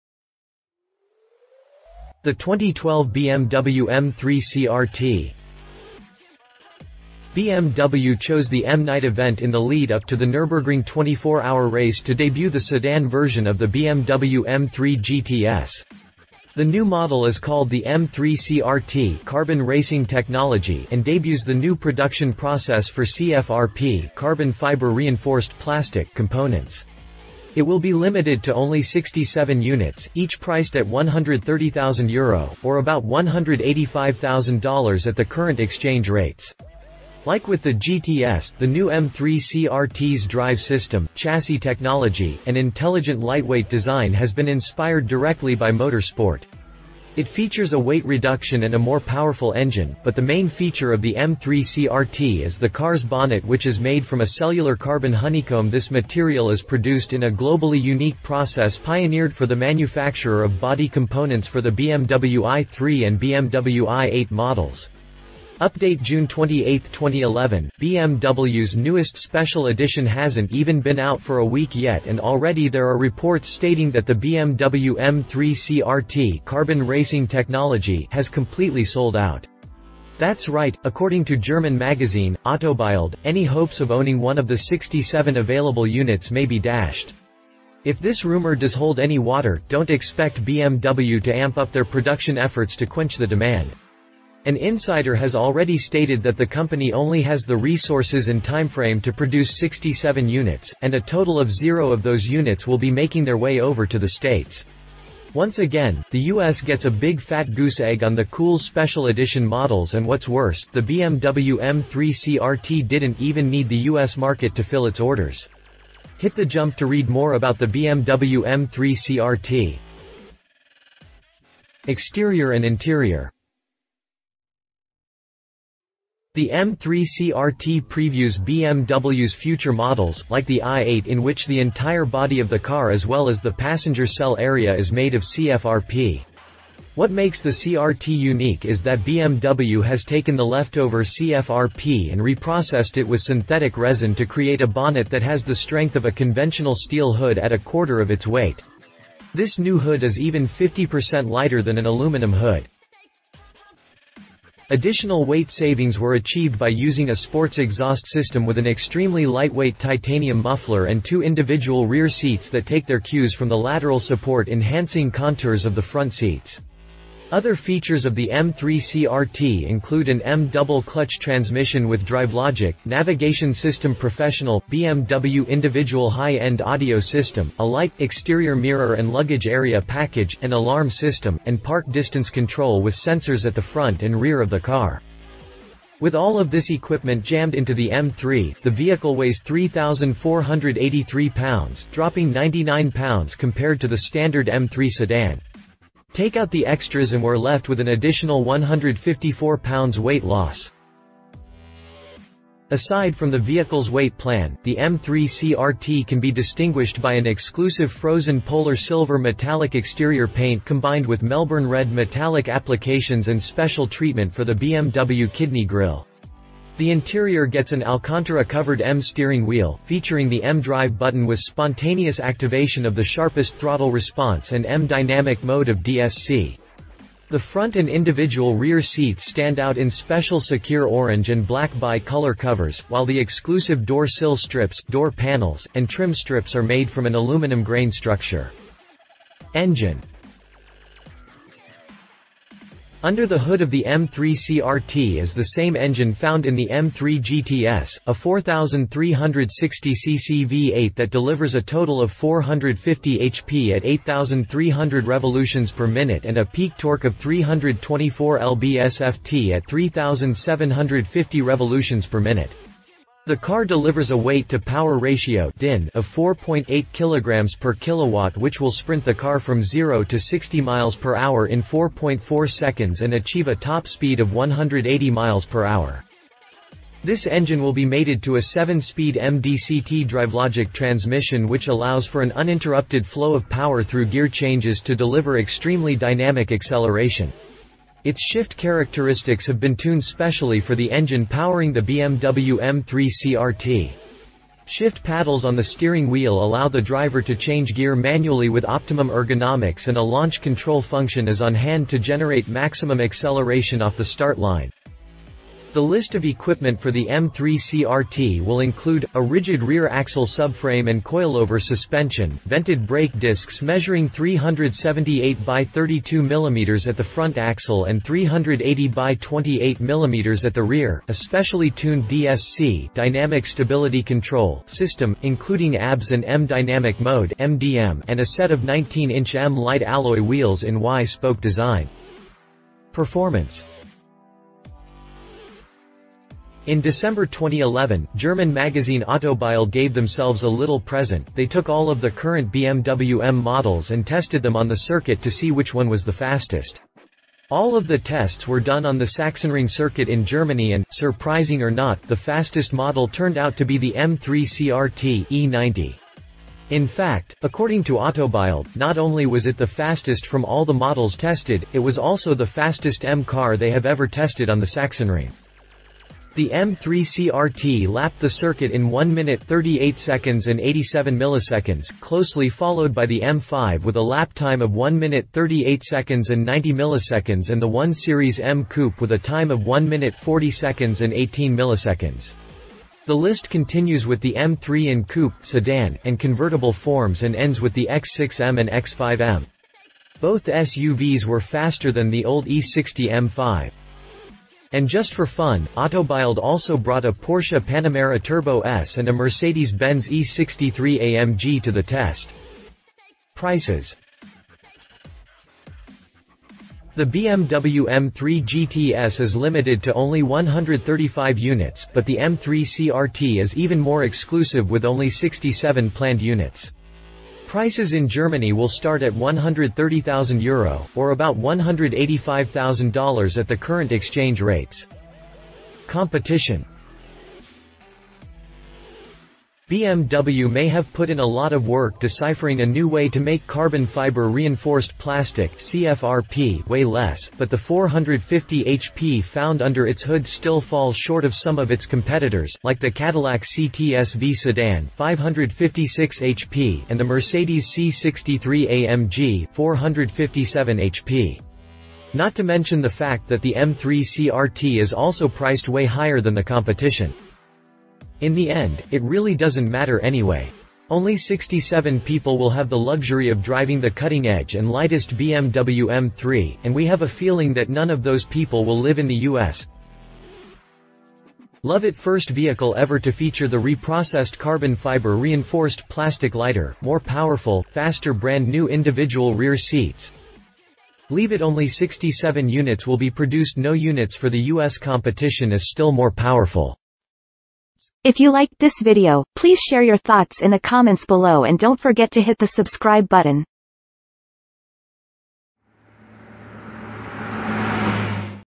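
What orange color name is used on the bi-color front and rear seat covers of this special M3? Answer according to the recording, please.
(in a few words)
Sakhir orange.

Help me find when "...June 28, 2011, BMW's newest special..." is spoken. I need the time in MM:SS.
01:06.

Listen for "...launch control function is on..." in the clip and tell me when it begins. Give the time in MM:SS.
05:00.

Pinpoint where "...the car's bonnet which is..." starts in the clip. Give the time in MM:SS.
00:52.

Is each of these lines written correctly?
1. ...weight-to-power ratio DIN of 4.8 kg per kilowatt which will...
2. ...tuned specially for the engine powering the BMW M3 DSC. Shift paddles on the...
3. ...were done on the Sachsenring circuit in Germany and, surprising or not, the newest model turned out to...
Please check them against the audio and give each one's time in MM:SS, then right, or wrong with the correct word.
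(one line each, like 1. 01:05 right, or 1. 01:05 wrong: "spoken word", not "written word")
1. 04:24 right
2. 04:49 wrong: "CRT", not "DSC"
3. 05:48 wrong: "fastest", not "newest".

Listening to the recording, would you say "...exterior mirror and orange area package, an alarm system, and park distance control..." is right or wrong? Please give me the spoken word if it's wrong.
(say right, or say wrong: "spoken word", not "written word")
wrong: "luggage", not "orange".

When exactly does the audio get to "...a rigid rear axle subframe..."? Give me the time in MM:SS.
05:09.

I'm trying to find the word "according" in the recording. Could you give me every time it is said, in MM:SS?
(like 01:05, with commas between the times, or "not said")
01:20, 05:57.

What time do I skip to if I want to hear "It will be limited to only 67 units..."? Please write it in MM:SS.
00:27.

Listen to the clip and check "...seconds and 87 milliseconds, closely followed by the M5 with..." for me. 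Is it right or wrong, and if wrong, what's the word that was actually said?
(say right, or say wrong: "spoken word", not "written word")
right.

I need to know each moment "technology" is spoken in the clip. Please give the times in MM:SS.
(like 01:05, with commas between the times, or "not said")
00:20, 00:41, 01:17.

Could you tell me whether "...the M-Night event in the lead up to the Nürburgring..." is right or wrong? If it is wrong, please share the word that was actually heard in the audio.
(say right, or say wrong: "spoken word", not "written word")
right.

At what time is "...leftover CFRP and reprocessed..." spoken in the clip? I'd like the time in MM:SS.
02:20.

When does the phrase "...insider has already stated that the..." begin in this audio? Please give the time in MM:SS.
01:34.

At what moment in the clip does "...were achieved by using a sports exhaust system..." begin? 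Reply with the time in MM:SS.
02:35.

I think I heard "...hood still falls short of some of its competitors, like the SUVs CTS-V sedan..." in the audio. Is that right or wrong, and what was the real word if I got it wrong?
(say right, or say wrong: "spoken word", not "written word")
wrong: "Cadillac", not "SUVs".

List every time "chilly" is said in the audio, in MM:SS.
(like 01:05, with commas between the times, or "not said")
not said.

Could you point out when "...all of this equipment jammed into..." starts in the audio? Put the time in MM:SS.
03:06.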